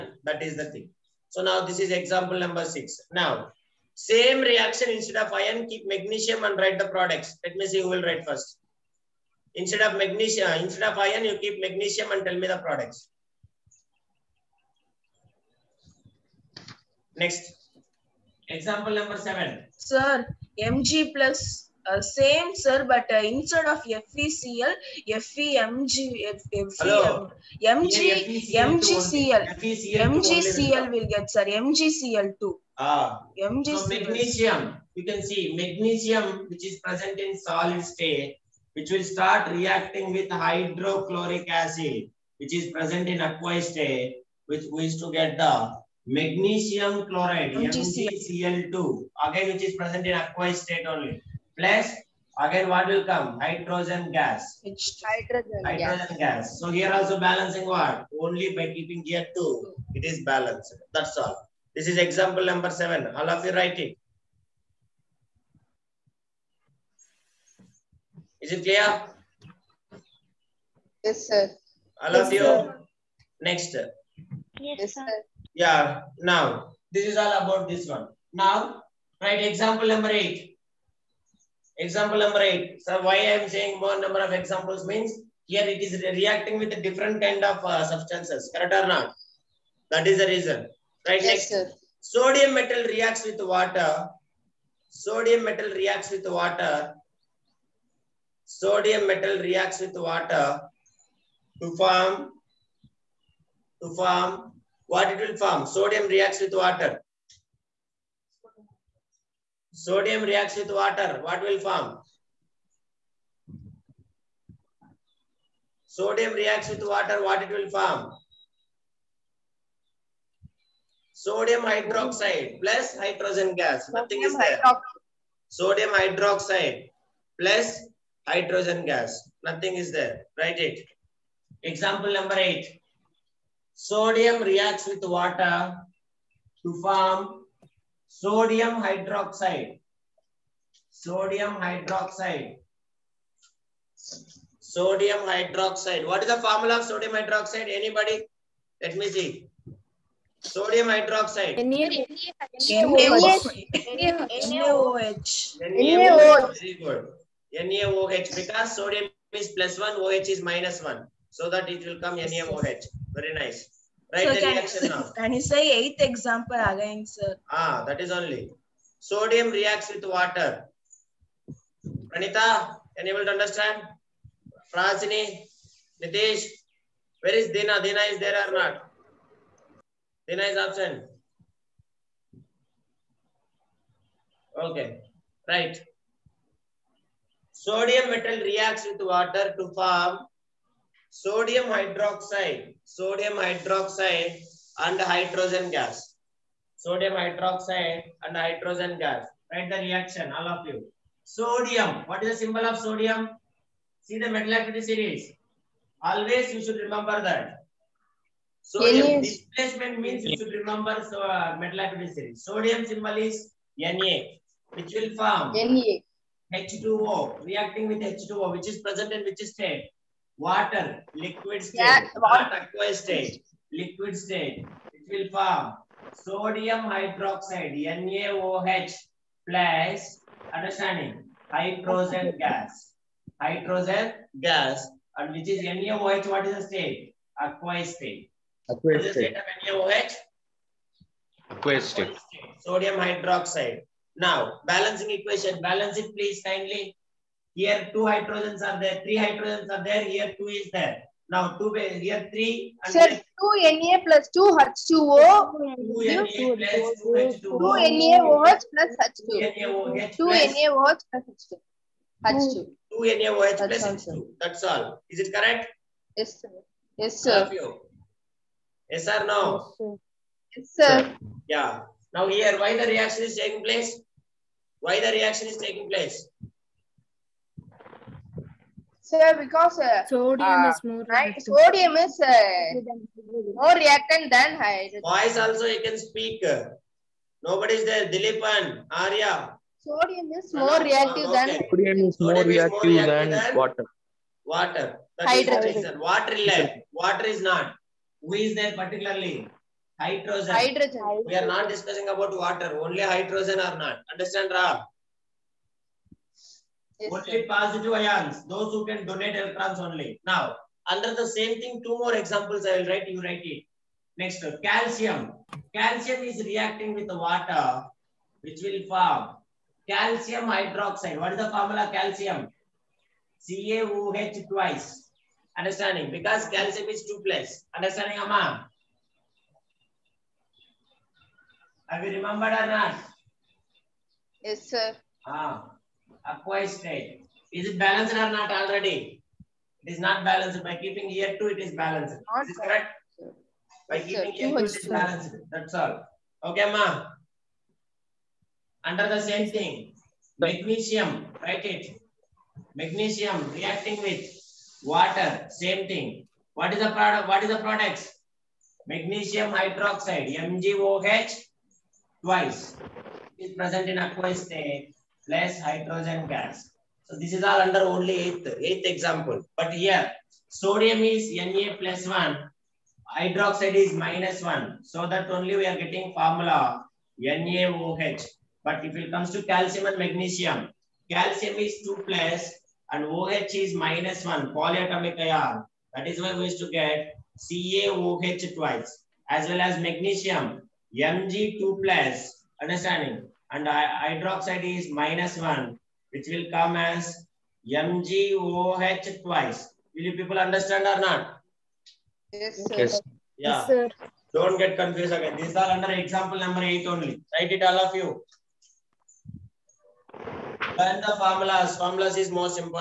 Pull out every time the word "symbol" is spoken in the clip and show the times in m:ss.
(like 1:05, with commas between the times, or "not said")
3:22, 3:32.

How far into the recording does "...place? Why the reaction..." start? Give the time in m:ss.
4:33.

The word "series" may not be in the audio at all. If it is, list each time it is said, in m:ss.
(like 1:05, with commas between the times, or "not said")
3:24, 3:32.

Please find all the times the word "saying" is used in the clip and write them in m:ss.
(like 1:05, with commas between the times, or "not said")
1:23.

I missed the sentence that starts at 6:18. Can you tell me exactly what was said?
But if it comes to calcium and magnesium, calcium is 2 plus and OH is minus 1, polyatomic ion.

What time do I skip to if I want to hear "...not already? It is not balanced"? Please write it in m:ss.
5:38.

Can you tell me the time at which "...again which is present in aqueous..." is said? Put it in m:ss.
0:49.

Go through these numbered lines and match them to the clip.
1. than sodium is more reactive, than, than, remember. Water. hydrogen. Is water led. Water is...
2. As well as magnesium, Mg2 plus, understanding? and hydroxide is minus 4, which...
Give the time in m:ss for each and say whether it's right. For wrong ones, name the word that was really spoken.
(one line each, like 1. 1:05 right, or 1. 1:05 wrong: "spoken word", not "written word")
1. 4:51 wrong: "water", not "remember"
2. 6:29 wrong: "1", not "4".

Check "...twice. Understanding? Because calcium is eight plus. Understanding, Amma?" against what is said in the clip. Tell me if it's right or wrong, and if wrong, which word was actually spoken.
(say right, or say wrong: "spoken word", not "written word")
wrong: "two", not "eight".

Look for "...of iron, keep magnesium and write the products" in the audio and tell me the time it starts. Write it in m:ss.
0:05.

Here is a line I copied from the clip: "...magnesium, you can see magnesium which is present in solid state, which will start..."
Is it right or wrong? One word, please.
right.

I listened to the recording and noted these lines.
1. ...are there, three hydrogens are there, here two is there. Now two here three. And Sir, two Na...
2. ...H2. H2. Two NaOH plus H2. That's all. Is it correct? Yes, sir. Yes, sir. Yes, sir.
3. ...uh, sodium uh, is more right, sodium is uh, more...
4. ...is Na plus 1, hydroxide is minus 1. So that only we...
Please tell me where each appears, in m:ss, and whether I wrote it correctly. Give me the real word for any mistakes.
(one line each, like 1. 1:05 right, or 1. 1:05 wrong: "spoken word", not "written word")
1. 4:08 right
2. 4:21 right
3. 4:39 right
4. 6:10 right.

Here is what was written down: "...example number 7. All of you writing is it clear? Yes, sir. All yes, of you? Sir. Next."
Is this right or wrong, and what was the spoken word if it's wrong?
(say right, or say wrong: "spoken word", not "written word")
right.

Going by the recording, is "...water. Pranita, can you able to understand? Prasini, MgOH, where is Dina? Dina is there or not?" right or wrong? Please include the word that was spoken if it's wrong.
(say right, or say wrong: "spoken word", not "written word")
wrong: "Nitesh", not "MgOH".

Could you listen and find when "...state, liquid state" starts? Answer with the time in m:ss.
3:43.